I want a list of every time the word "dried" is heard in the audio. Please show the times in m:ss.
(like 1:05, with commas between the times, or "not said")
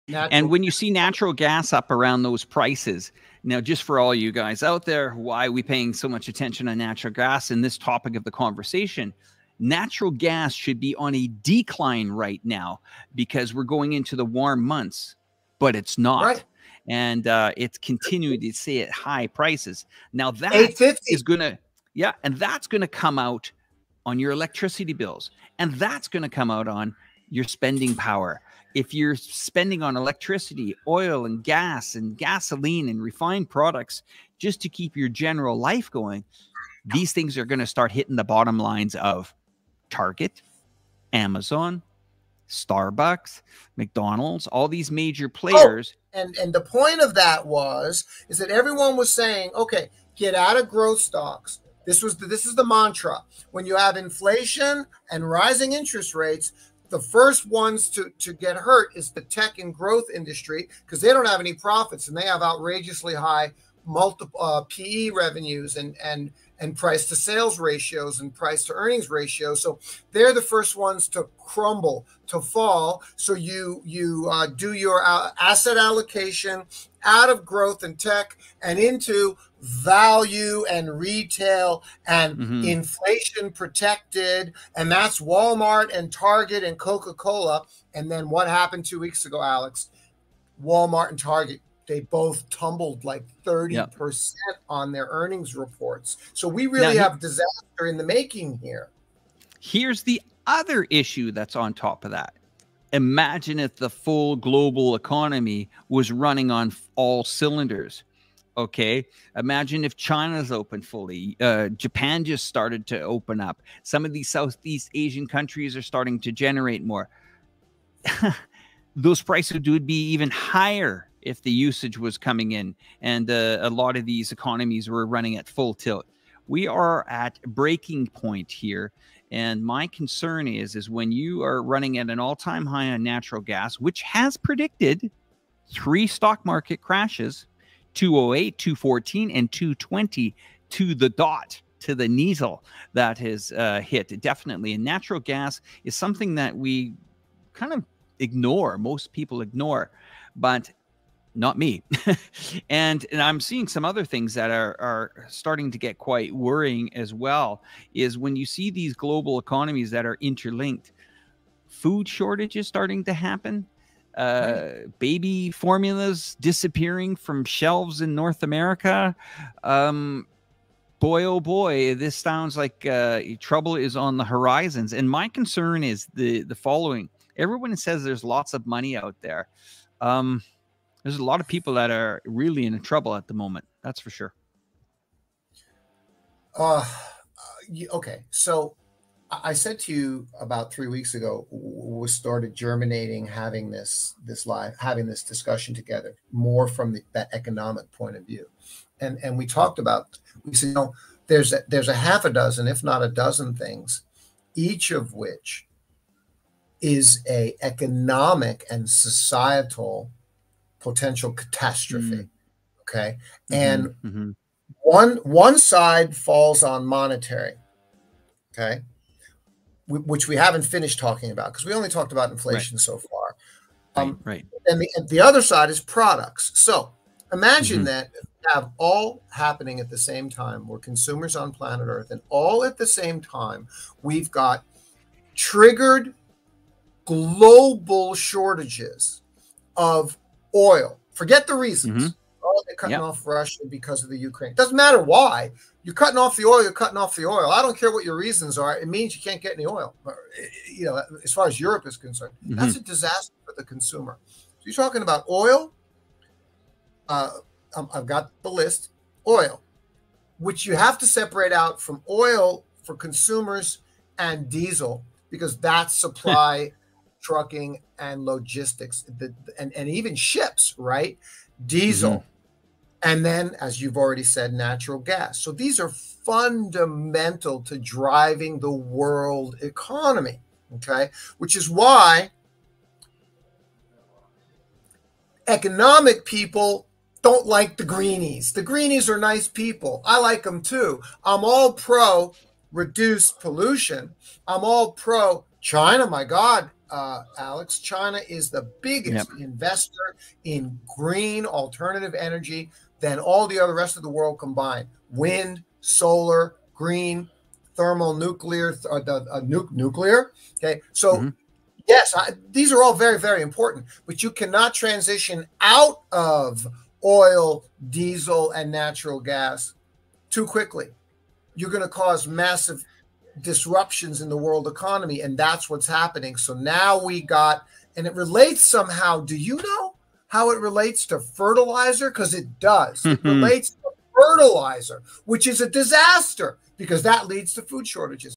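not said.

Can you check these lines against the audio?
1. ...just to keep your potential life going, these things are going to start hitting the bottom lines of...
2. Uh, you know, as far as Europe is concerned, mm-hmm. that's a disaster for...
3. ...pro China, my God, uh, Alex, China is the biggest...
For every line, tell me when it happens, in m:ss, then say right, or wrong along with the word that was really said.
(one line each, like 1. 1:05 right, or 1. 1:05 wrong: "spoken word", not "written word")
1. 0:34 wrong: "general", not "potential"
2. 4:10 right
3. 4:54 right.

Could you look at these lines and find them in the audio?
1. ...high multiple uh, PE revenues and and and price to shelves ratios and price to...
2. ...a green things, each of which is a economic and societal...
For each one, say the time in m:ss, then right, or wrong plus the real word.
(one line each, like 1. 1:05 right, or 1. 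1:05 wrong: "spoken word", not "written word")
1. 1:03 wrong: "sales", not "shelves"
2. 3:23 wrong: "dozen", not "green".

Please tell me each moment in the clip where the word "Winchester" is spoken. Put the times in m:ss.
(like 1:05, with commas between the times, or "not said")
not said.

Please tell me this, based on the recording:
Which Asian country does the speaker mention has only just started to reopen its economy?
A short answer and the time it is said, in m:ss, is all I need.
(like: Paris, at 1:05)
Japan, at 1:51.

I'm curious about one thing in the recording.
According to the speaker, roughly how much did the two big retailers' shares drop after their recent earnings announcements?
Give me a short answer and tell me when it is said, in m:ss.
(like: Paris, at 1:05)
30%, at 1:33.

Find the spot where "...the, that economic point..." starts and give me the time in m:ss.
3:16.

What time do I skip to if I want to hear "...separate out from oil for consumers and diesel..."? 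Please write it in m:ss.
4:21.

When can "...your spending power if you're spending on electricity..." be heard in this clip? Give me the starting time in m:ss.
0:27.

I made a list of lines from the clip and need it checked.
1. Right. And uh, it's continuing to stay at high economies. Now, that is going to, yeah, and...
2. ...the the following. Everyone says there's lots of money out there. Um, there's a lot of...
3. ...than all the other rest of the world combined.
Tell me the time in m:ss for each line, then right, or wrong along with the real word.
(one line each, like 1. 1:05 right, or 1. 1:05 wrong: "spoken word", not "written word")
1. 0:16 wrong: "prices", not "economies"
2. 2:56 right
3. 5:02 right.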